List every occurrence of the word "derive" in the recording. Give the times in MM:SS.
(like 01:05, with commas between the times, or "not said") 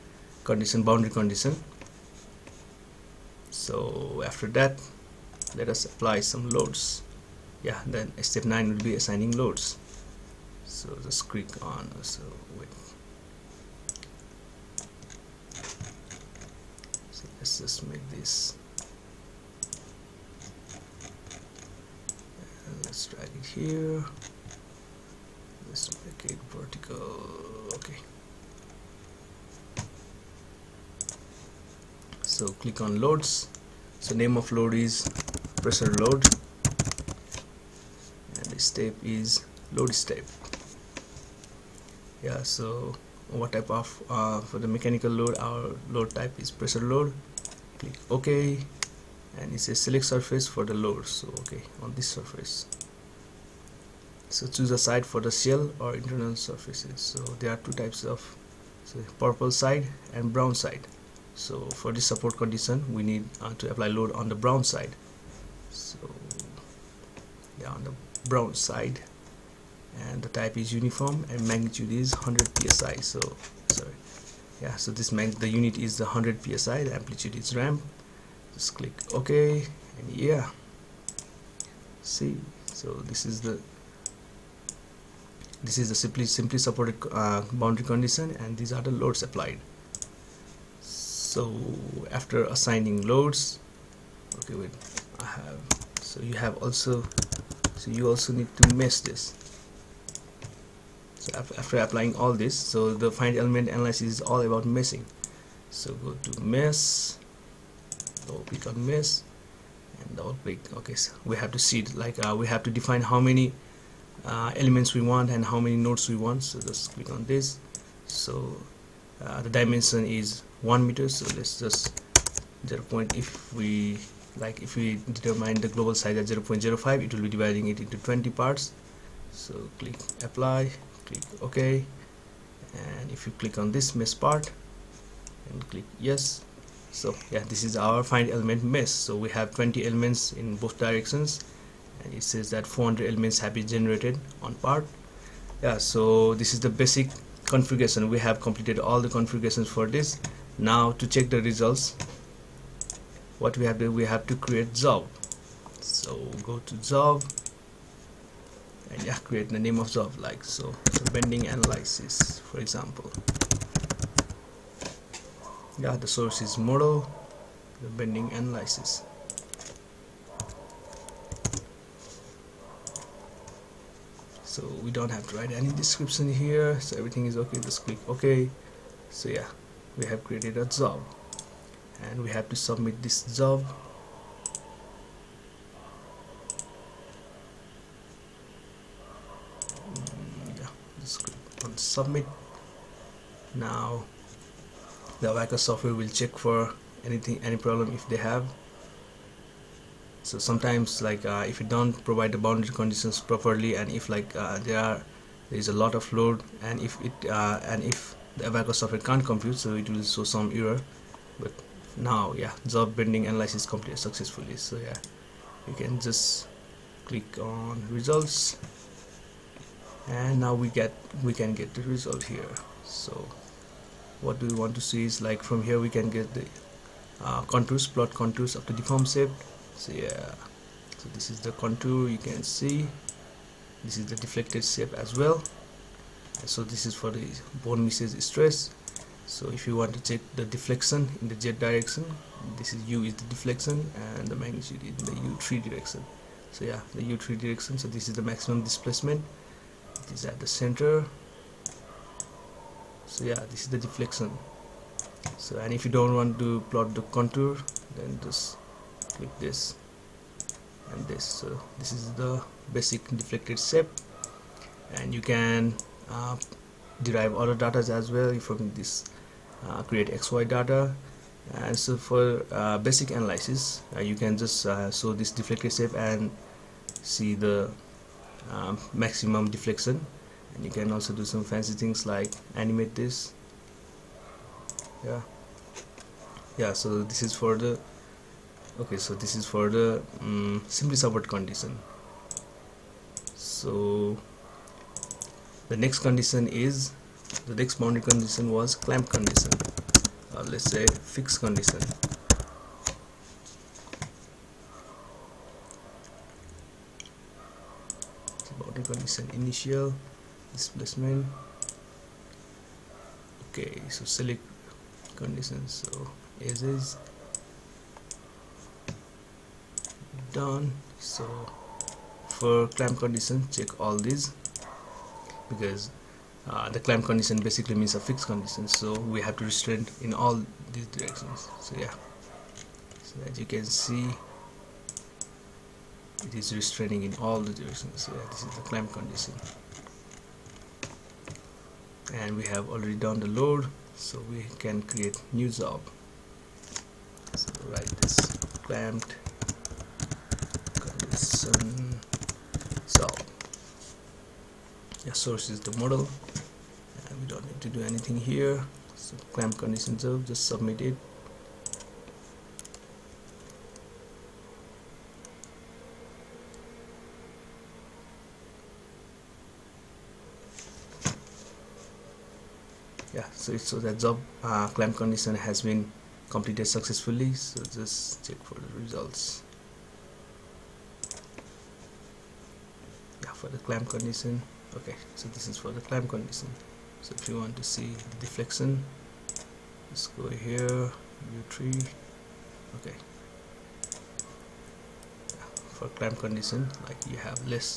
04:27.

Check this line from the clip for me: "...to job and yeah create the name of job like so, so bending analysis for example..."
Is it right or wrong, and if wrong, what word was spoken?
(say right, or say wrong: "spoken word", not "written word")
right.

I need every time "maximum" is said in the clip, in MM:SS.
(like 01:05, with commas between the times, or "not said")
04:08, 04:38.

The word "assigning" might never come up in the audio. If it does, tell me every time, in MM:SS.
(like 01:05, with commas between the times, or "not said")
00:08, 01:32.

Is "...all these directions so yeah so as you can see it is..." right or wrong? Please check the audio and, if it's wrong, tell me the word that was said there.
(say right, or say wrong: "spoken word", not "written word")
right.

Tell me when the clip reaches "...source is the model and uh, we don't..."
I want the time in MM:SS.
05:55.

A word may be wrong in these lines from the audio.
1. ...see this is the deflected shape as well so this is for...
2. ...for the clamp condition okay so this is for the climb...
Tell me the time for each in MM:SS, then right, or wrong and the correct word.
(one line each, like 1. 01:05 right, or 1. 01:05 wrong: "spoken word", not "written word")
1. 03:52 right
2. 06:23 right.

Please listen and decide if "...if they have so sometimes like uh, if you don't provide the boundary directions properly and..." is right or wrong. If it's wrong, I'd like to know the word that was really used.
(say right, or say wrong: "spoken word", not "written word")
wrong: "conditions", not "directions".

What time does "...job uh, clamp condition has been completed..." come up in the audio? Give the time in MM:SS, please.
06:13.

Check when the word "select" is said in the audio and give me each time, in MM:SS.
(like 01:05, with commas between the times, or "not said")
00:49, 05:14.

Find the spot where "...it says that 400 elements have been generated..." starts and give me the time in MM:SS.
02:22.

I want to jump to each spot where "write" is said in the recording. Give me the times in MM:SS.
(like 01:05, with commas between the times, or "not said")
02:55, 05:47.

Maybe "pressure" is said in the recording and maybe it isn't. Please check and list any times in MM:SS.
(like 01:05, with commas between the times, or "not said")
00:35, 00:46.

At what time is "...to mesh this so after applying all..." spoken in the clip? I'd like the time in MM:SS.
01:38.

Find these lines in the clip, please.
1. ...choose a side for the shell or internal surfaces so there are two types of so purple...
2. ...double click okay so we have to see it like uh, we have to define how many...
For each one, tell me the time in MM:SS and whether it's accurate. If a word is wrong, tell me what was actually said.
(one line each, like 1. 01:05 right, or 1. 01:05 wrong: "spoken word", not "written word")
1. 00:54 right
2. 01:50 right.